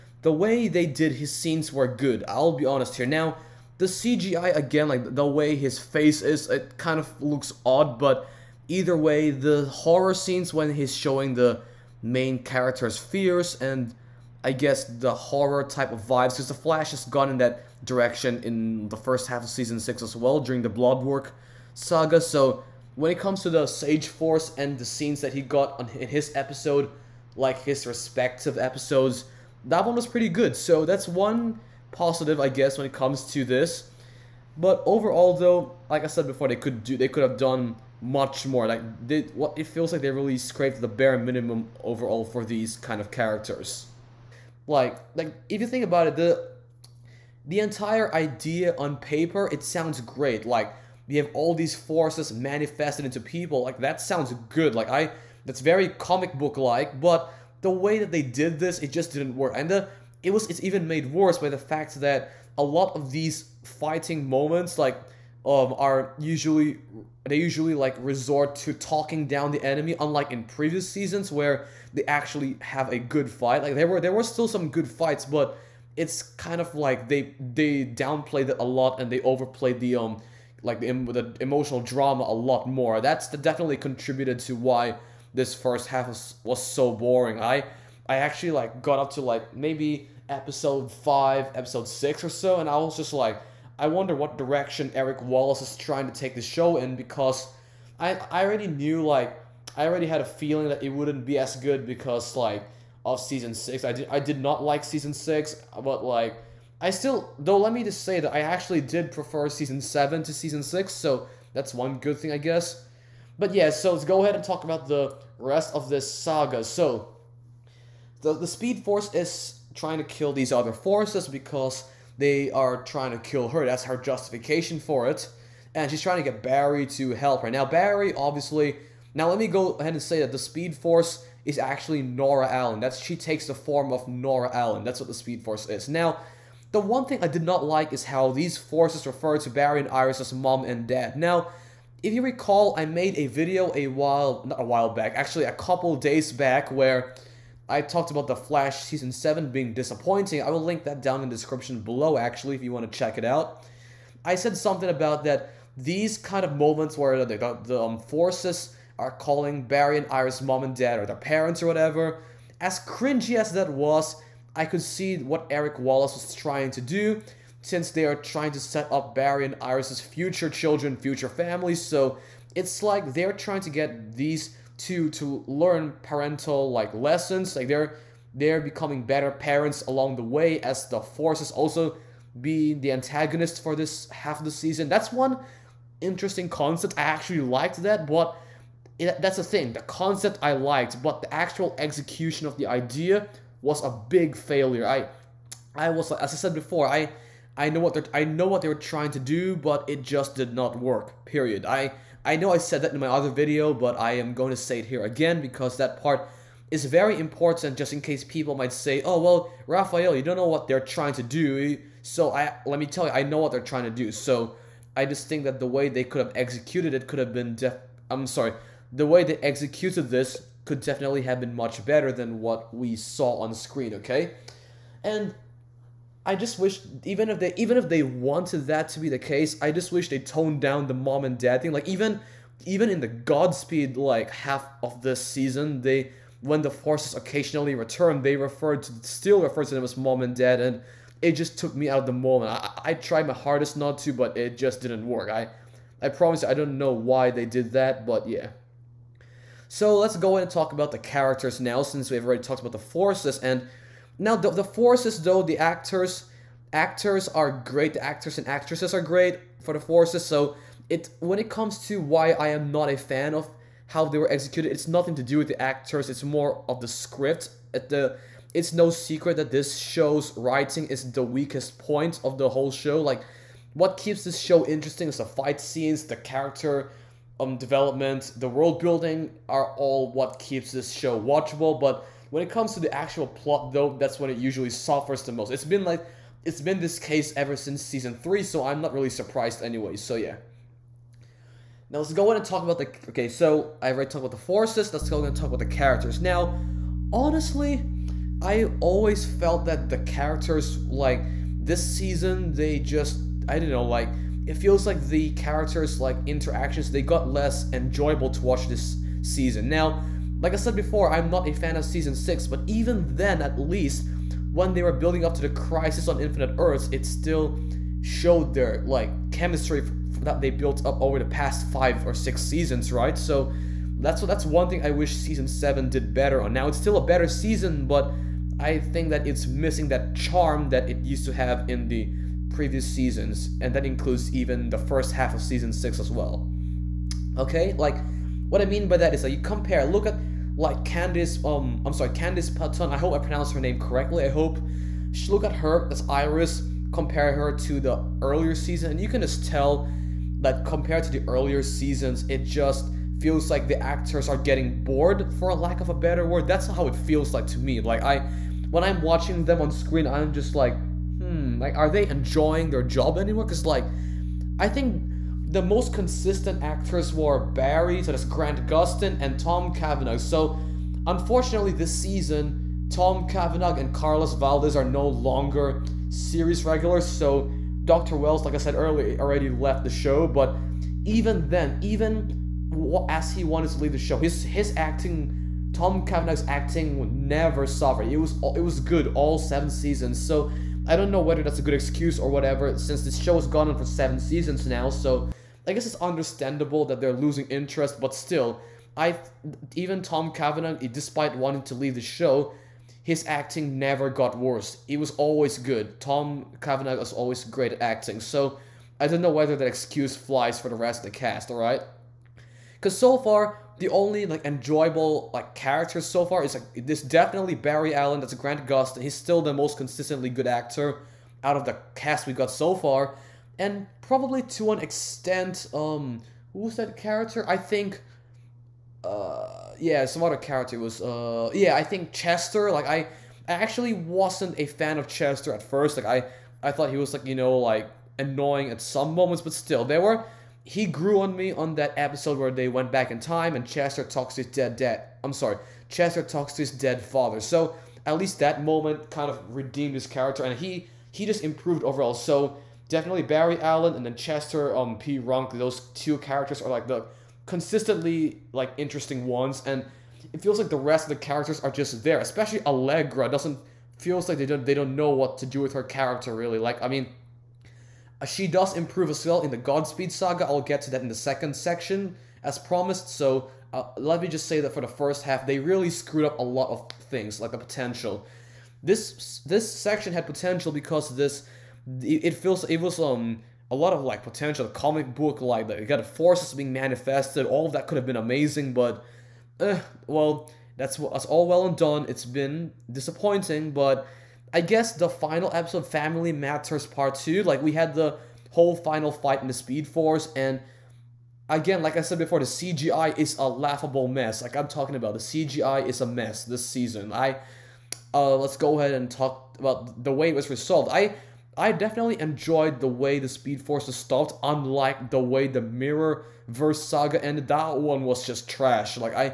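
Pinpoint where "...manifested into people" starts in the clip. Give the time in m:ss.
0:52.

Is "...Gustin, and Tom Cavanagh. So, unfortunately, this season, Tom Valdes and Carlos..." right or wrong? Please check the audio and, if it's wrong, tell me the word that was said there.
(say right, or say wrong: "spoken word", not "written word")
wrong: "Cavanagh", not "Valdes".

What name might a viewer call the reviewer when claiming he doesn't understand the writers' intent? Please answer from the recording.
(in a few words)
Rafael.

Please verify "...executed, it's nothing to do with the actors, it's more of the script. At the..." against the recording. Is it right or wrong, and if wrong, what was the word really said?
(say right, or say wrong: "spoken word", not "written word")
right.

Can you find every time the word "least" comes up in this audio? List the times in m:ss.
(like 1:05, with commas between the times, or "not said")
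5:13, 7:28.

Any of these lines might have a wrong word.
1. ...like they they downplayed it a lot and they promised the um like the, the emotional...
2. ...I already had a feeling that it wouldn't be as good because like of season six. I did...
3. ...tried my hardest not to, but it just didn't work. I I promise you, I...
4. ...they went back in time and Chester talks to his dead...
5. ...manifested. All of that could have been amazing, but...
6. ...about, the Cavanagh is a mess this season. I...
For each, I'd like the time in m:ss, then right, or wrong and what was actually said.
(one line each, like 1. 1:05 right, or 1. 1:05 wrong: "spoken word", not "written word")
1. 1:16 wrong: "overplayed", not "promised"
2. 1:39 right
3. 4:02 right
4. 7:22 right
5. 8:06 right
6. 8:24 wrong: "CGI", not "Cavanagh".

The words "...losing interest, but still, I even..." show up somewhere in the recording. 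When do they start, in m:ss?
6:37.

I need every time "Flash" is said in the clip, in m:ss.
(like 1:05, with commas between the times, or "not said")
0:16, 2:28.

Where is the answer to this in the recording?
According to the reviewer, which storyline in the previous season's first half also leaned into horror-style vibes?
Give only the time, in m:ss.
0:20.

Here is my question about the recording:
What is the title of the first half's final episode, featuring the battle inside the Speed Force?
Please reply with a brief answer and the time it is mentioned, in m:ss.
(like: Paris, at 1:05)
Family Matters Part 2, at 8:15.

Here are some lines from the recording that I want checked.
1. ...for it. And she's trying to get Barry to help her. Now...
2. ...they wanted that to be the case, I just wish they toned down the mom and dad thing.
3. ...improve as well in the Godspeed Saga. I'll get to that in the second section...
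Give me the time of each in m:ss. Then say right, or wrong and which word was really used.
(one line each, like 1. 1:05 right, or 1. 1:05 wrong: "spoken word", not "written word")
1. 2:04 right
2. 3:47 right
3. 7:48 right.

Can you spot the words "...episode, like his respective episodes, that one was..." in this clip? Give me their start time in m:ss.
0:26.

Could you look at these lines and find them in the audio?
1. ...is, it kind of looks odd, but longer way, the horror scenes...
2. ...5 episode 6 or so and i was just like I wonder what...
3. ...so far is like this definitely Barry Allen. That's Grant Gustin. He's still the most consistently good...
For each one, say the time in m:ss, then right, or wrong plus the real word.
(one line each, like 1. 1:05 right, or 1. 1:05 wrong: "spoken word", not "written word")
1. 0:06 wrong: "either", not "longer"
2. 1:30 right
3. 6:56 right.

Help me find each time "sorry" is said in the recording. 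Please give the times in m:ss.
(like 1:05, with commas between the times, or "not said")
3:38, 5:41, 7:25.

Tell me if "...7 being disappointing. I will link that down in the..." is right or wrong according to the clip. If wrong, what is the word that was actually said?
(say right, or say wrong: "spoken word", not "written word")
right.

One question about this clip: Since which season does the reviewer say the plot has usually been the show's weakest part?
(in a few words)
Season 3.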